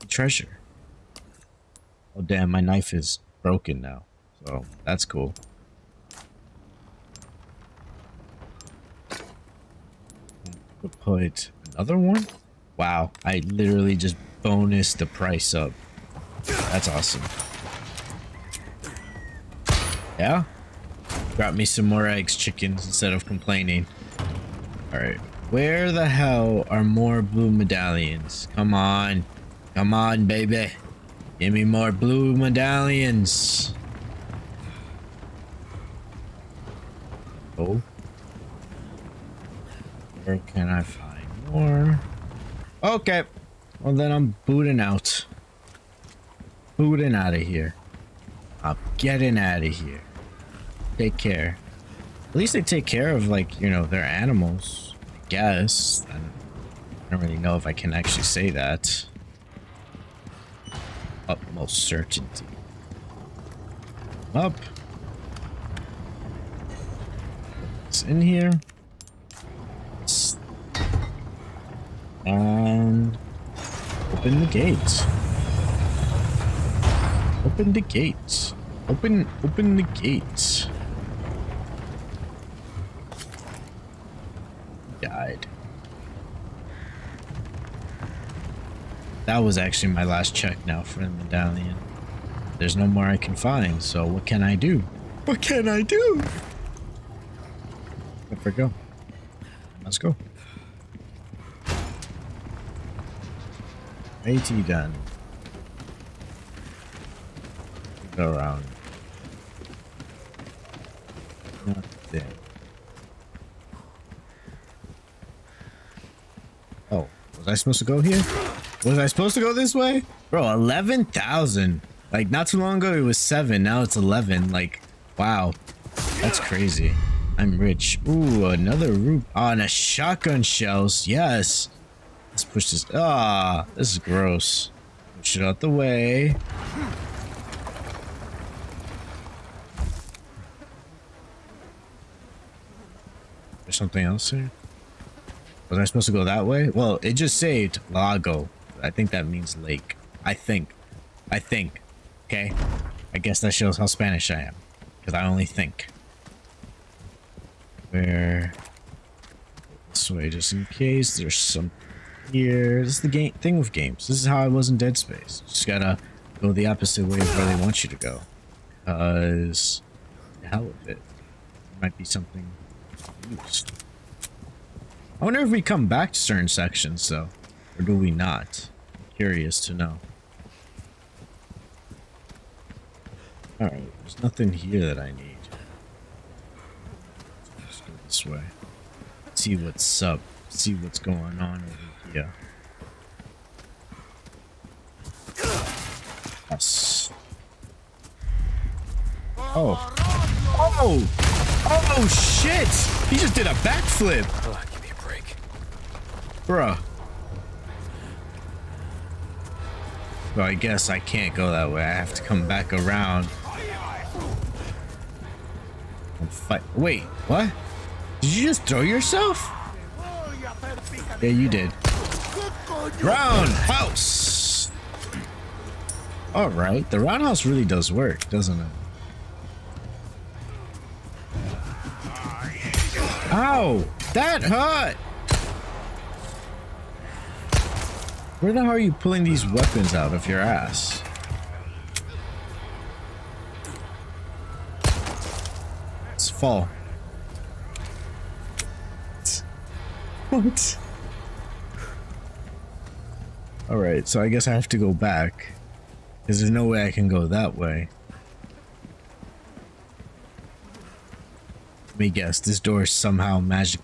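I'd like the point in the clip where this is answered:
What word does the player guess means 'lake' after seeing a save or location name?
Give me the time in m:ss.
2:27.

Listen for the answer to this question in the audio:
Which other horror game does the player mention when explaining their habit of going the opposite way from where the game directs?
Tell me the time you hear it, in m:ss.
2:44.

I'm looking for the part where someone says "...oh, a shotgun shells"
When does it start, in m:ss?
2:09.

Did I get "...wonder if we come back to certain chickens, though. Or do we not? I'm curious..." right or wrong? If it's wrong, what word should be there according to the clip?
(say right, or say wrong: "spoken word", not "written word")
wrong: "sections", not "chickens".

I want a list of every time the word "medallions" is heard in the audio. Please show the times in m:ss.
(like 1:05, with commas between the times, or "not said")
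0:27, 0:32, 1:31.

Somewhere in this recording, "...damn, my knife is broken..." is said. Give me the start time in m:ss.
0:02.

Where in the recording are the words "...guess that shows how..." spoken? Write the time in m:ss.
2:33.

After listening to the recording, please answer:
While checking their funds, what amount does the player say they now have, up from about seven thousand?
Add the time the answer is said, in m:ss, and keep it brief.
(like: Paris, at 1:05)
11,000, at 2:00.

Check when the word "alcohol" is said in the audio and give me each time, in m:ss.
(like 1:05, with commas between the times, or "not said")
not said.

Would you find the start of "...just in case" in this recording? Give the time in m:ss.
2:40.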